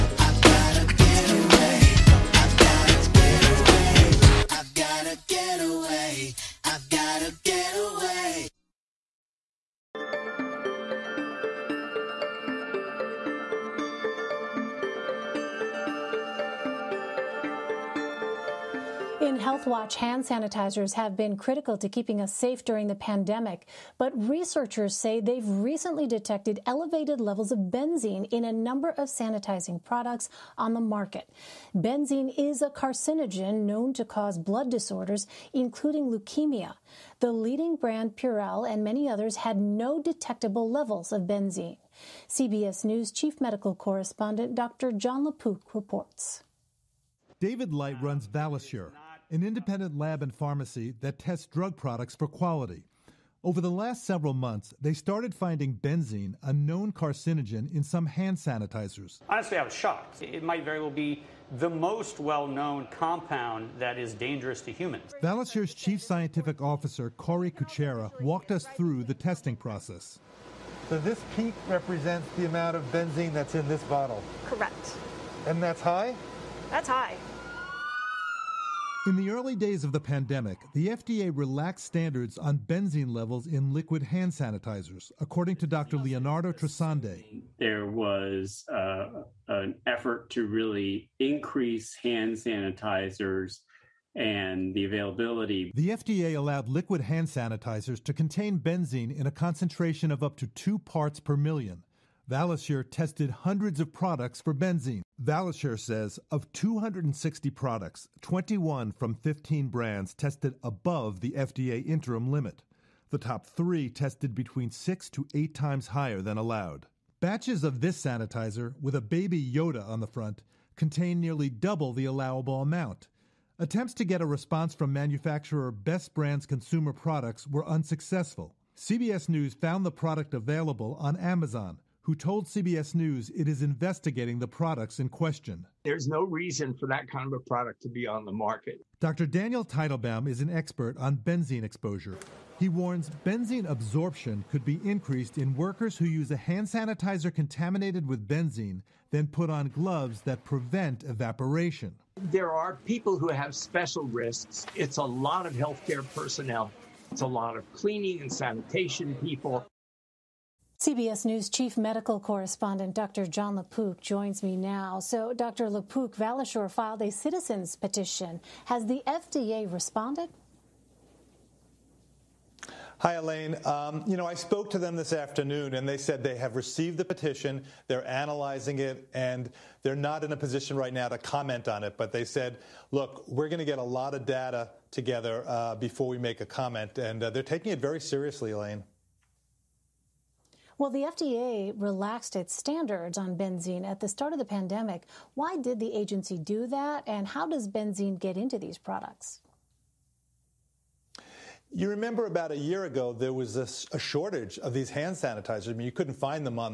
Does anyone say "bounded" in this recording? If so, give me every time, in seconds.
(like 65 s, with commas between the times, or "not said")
not said.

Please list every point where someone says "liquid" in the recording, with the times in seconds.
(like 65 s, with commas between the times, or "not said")
83 s, 96 s.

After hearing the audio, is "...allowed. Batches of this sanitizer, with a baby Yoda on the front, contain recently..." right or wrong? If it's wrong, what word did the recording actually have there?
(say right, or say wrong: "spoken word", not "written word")
wrong: "nearly", not "recently".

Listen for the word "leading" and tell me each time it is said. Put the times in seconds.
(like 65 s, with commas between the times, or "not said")
37 s.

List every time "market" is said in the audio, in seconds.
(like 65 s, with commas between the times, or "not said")
30 s, 138 s.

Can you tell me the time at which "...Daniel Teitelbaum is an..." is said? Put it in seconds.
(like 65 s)
139 s.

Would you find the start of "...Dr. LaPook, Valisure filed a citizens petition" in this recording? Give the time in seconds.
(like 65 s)
165 s.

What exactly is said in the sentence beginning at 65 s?
Valisure's chief scientific officer, Kaury Kucera, walked us through the testing process.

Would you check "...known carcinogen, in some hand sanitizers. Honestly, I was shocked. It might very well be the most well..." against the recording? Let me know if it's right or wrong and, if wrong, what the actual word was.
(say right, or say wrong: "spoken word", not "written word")
right.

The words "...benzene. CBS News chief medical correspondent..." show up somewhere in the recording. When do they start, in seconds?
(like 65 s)
41 s.